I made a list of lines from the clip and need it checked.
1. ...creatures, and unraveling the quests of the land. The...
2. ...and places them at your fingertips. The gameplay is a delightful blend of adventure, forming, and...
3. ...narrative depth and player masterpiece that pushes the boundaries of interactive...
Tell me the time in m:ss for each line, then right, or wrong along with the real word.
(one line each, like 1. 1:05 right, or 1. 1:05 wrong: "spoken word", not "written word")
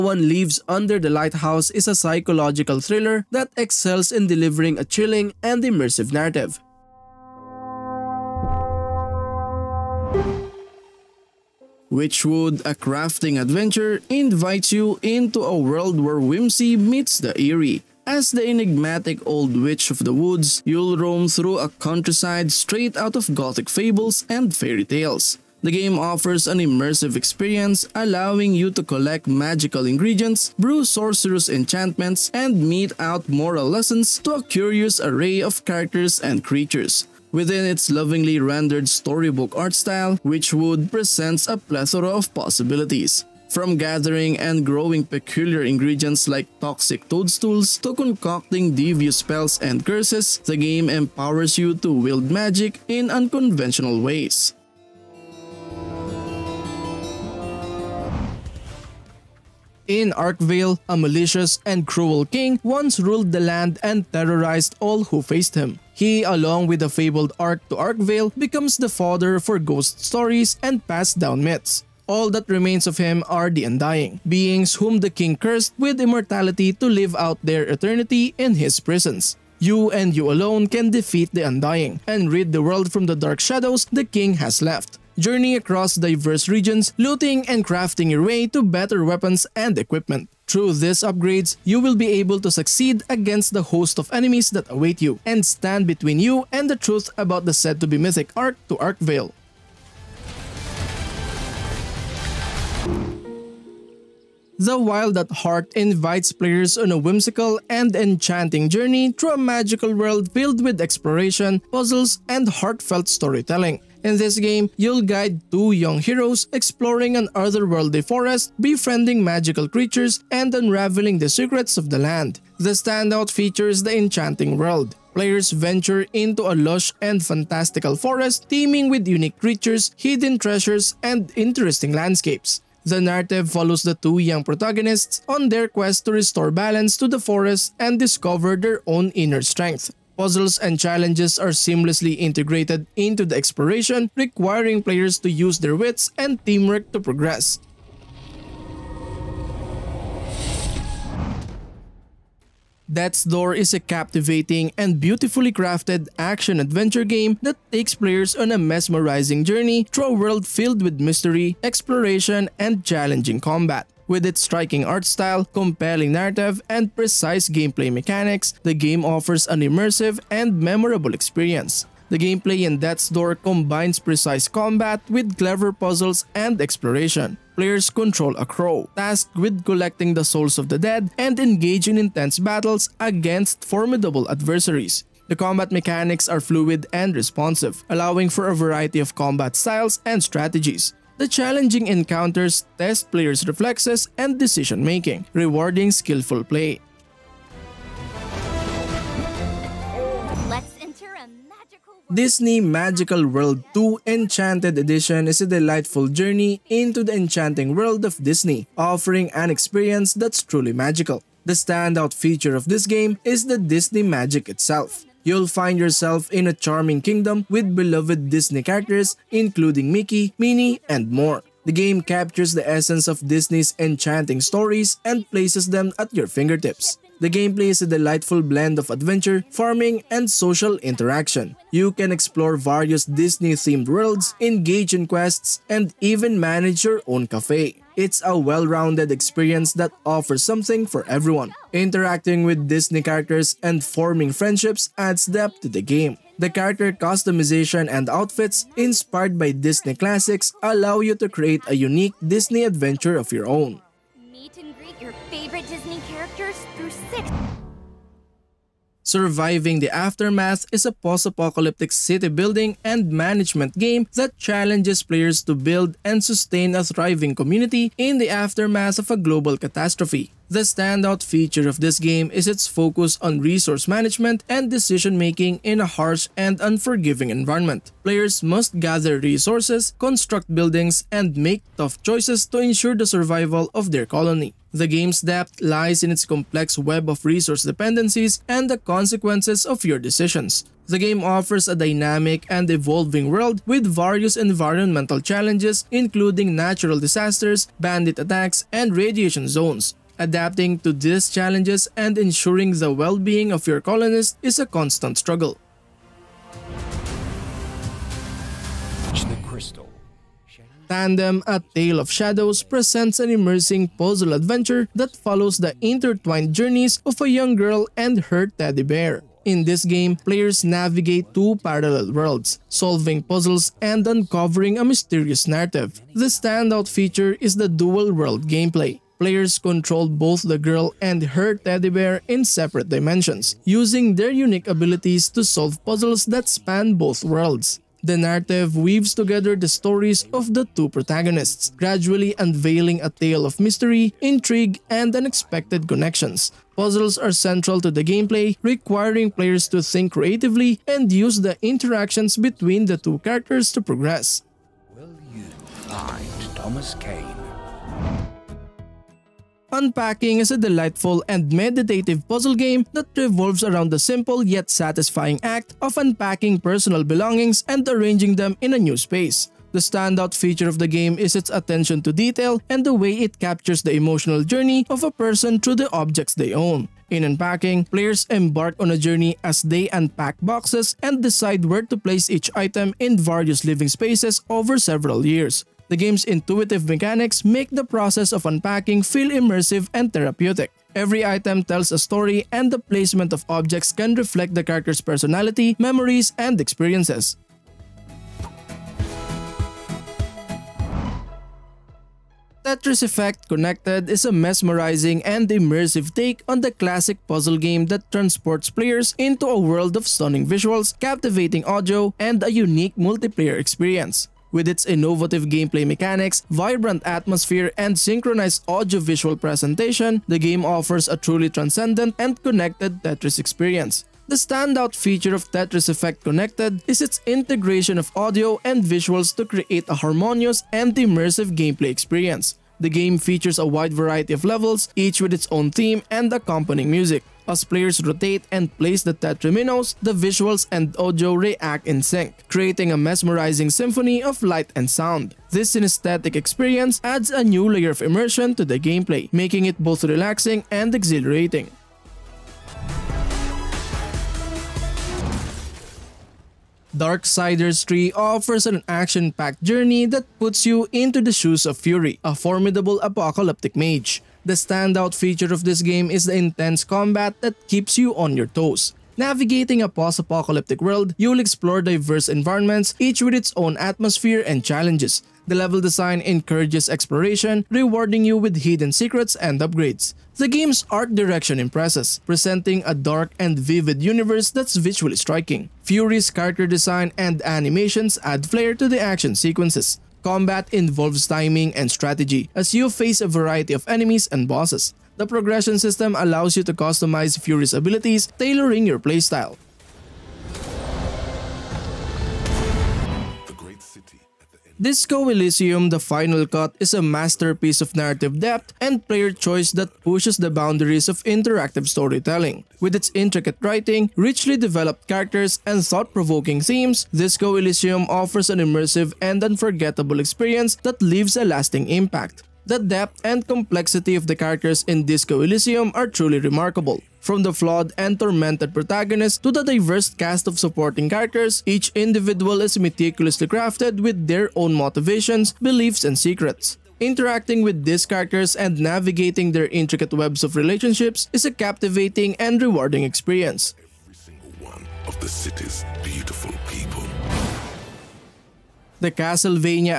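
1. 1:59 wrong: "secrets", not "quests"
2. 3:45 wrong: "farming", not "forming"
3. 8:27 wrong: "choice", not "masterpiece".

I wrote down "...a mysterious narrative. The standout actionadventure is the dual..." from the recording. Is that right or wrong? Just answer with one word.
wrong.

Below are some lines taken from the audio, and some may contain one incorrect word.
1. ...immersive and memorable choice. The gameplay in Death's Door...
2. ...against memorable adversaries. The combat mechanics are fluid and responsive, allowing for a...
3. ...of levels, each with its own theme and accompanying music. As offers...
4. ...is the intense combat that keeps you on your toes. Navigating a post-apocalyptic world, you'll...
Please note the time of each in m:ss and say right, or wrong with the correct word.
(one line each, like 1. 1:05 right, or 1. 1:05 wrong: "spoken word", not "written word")
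1. 2:49 wrong: "experience", not "choice"
2. 3:02 wrong: "formidable", not "memorable"
3. 7:14 wrong: "players", not "offers"
4. 7:46 right.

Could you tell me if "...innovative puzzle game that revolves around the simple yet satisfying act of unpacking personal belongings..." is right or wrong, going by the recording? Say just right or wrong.
wrong.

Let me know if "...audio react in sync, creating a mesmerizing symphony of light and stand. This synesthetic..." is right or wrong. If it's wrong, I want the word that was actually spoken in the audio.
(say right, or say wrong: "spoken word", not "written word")
wrong: "sound", not "stand".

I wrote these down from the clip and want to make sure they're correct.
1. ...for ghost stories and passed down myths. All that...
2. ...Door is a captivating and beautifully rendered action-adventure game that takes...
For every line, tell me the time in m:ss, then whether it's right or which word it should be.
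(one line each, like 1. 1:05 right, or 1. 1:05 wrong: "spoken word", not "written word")
1. 1:09 right
2. 2:33 wrong: "crafted", not "rendered".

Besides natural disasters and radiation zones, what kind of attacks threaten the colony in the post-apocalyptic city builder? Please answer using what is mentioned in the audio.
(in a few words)
bandit attacks.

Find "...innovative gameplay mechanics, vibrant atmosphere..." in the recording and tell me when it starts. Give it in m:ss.
6:54.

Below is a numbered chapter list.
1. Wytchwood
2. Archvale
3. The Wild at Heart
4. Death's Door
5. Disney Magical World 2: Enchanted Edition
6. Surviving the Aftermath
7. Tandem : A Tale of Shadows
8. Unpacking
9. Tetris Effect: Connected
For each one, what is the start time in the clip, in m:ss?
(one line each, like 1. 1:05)
1. 0:09
2. 0:57
3. 1:42
4. 2:30
5. 3:19
6. 4:16
7. 5:08
8. 5:57
9. 6:40.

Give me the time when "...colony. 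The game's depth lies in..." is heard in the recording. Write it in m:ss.
4:44.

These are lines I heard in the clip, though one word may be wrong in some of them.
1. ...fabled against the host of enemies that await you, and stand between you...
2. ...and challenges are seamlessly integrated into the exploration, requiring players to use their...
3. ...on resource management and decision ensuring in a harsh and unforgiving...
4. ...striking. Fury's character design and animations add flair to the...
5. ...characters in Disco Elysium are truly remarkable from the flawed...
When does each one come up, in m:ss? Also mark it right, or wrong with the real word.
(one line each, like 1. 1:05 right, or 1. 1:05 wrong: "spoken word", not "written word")
1. 1:32 wrong: "succeed", not "fabled"
2. 2:20 right
3. 4:33 wrong: "making", not "ensuring"
4. 8:05 right
5. 8:44 right.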